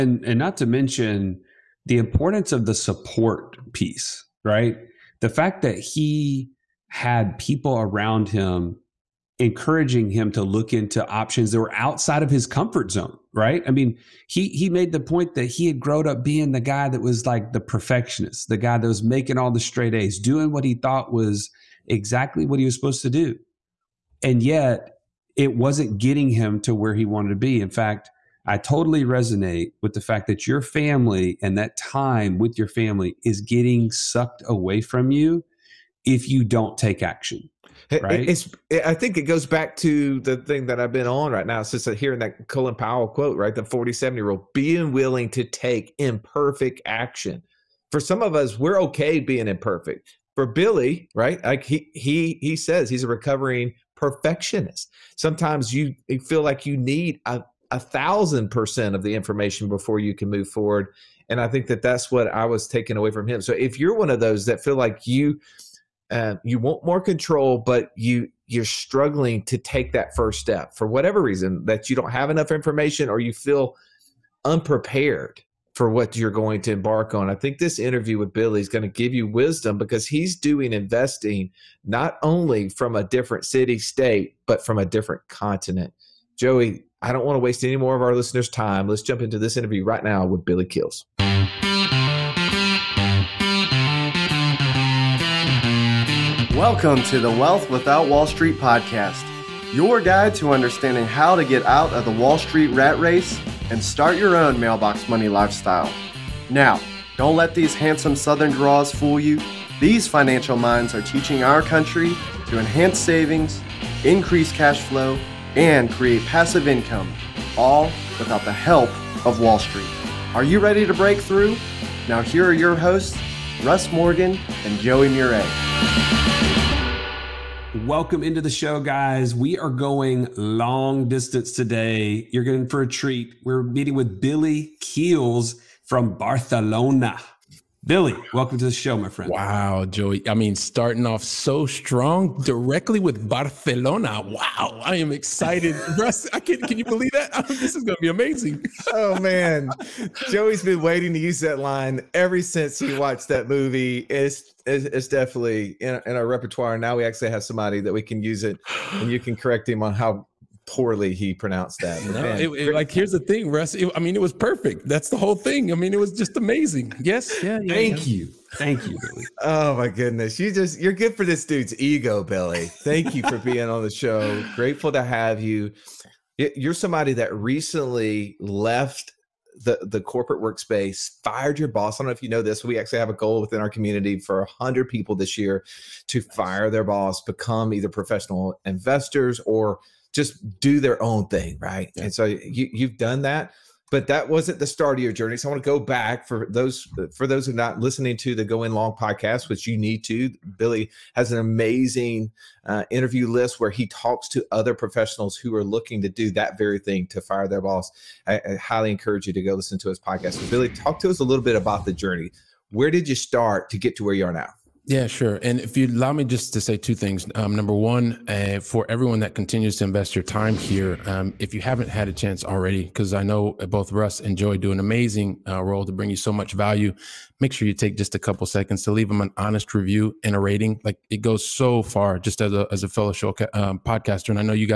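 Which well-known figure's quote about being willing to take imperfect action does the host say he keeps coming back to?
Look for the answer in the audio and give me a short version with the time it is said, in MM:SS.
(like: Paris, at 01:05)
Colin Powell, at 00:42.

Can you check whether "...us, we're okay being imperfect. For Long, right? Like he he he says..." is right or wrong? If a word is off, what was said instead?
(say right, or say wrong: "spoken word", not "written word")
wrong: "Billy", not "Long".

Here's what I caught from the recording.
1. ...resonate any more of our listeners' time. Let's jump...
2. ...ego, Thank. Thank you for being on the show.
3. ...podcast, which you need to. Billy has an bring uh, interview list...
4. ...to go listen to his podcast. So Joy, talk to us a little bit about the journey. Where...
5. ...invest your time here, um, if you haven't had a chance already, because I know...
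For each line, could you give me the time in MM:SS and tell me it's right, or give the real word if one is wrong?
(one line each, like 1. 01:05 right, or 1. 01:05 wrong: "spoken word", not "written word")
1. 01:27 wrong: "waste", not "resonate"
2. 02:51 wrong: "Billy", not "Thank"
3. 03:18 wrong: "amazing", not "bring"
4. 03:29 wrong: "Billy", not "Joy"
5. 03:39 right.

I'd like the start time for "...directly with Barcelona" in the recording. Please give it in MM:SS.
02:22.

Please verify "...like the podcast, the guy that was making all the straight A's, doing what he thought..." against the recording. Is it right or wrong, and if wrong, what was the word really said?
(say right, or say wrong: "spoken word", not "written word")
wrong: "perfectionist", not "podcast".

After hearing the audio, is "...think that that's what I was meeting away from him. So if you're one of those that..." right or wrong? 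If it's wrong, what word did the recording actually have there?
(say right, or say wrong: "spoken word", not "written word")
wrong: "taking", not "meeting".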